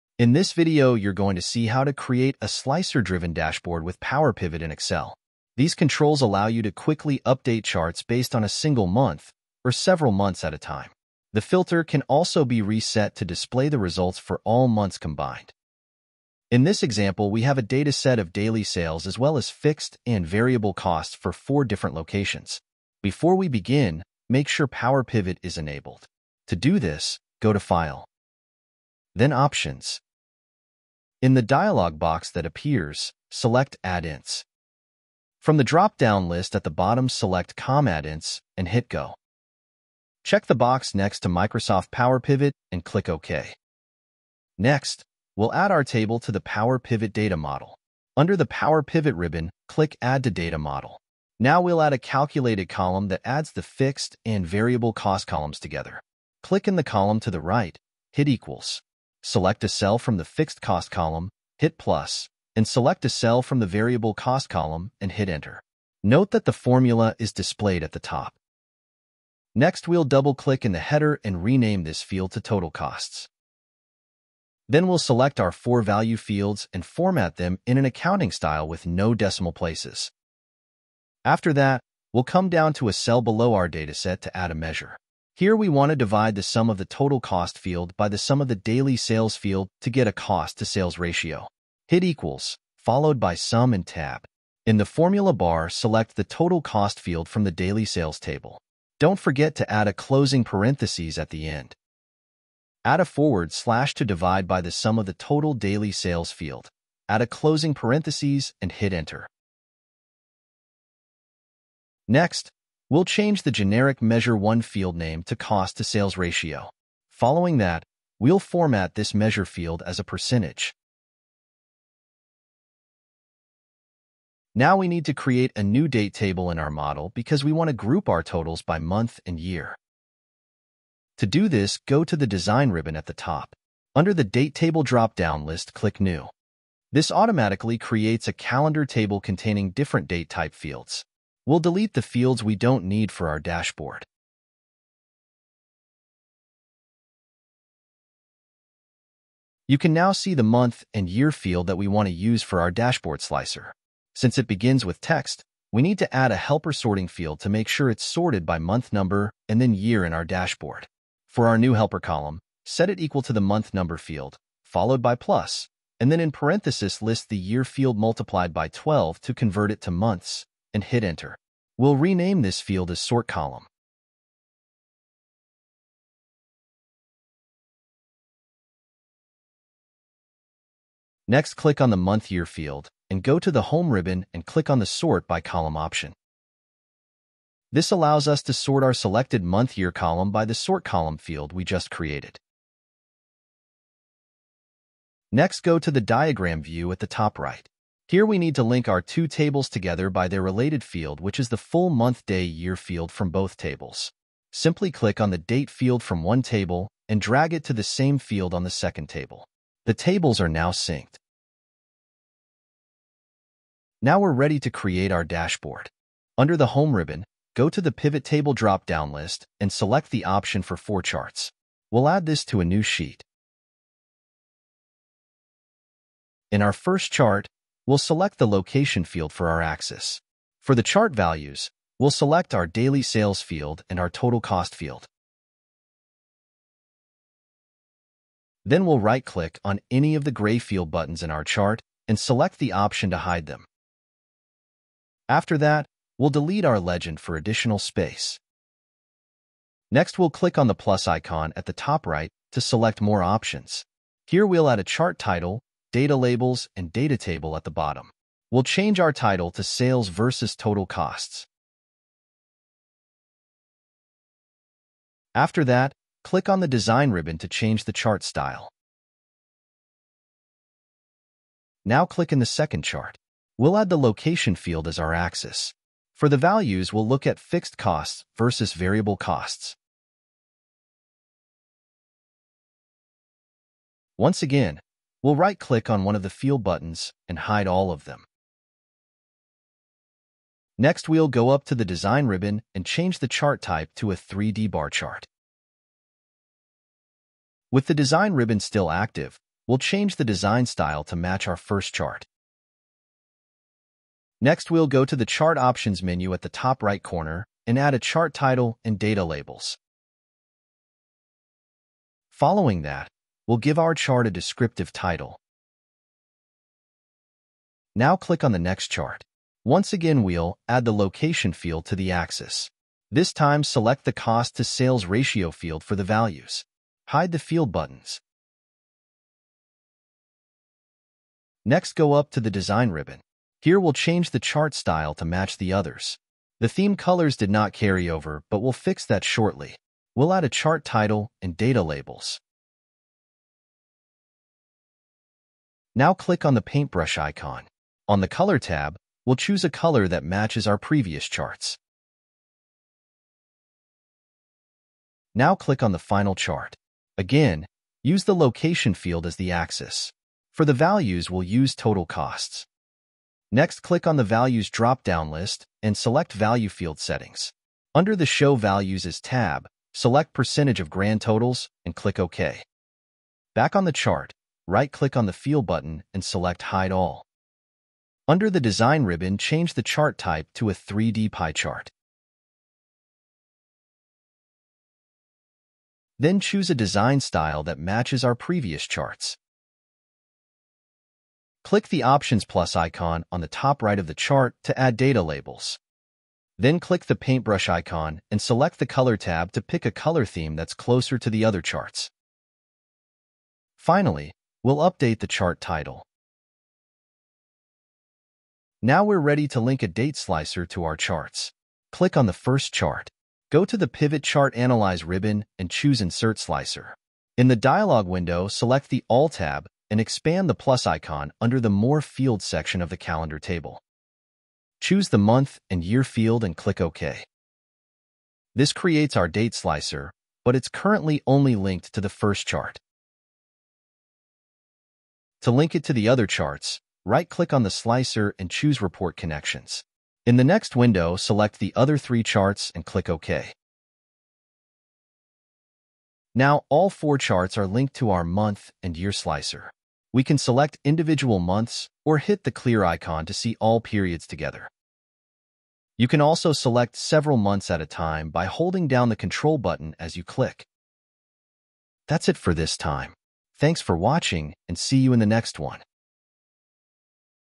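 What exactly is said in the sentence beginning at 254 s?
Here we'll add a chart title data labels, and data table at the bottom.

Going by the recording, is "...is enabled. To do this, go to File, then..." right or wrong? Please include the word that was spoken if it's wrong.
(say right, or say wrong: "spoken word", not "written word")
right.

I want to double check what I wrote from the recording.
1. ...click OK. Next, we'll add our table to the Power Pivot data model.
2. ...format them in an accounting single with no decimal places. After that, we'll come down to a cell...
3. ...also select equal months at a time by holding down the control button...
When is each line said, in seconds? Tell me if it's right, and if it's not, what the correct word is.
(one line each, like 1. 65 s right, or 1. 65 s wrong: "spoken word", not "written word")
1. 42 s right
2. 76 s wrong: "style", not "single"
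3. 456 s wrong: "several", not "equal".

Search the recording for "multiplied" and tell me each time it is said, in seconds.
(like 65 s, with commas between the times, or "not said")
167 s.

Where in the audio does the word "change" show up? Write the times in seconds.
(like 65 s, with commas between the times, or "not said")
113 s, 258 s, 267 s, 292 s, 299 s, 333 s, 379 s.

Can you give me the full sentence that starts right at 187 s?
This allows us to sort our selected month year column by the sort column field we just created.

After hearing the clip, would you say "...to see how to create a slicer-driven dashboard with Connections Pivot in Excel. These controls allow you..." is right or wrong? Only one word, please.
wrong.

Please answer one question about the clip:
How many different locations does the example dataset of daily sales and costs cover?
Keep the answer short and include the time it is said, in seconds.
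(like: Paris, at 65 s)
4, at 21 s.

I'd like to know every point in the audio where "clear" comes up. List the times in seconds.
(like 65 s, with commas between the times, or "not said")
452 s.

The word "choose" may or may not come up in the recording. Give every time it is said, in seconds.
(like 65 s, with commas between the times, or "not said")
349 s, 386 s, 415 s, 424 s, 438 s.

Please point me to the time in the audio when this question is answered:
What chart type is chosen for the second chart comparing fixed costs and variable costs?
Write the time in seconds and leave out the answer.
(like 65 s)
294 s.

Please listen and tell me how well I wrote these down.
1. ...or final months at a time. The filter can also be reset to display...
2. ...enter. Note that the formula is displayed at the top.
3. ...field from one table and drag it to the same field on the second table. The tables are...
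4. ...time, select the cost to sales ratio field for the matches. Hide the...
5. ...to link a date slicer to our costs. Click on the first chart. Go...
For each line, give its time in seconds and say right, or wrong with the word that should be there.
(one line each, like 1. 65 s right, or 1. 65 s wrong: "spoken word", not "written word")
1. 9 s wrong: "several", not "final"
2. 65 s right
3. 205 s right
4. 323 s wrong: "values", not "matches"
5. 409 s wrong: "charts", not "costs".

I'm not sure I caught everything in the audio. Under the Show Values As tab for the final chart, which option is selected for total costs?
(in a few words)
Percentage of Grand Totals.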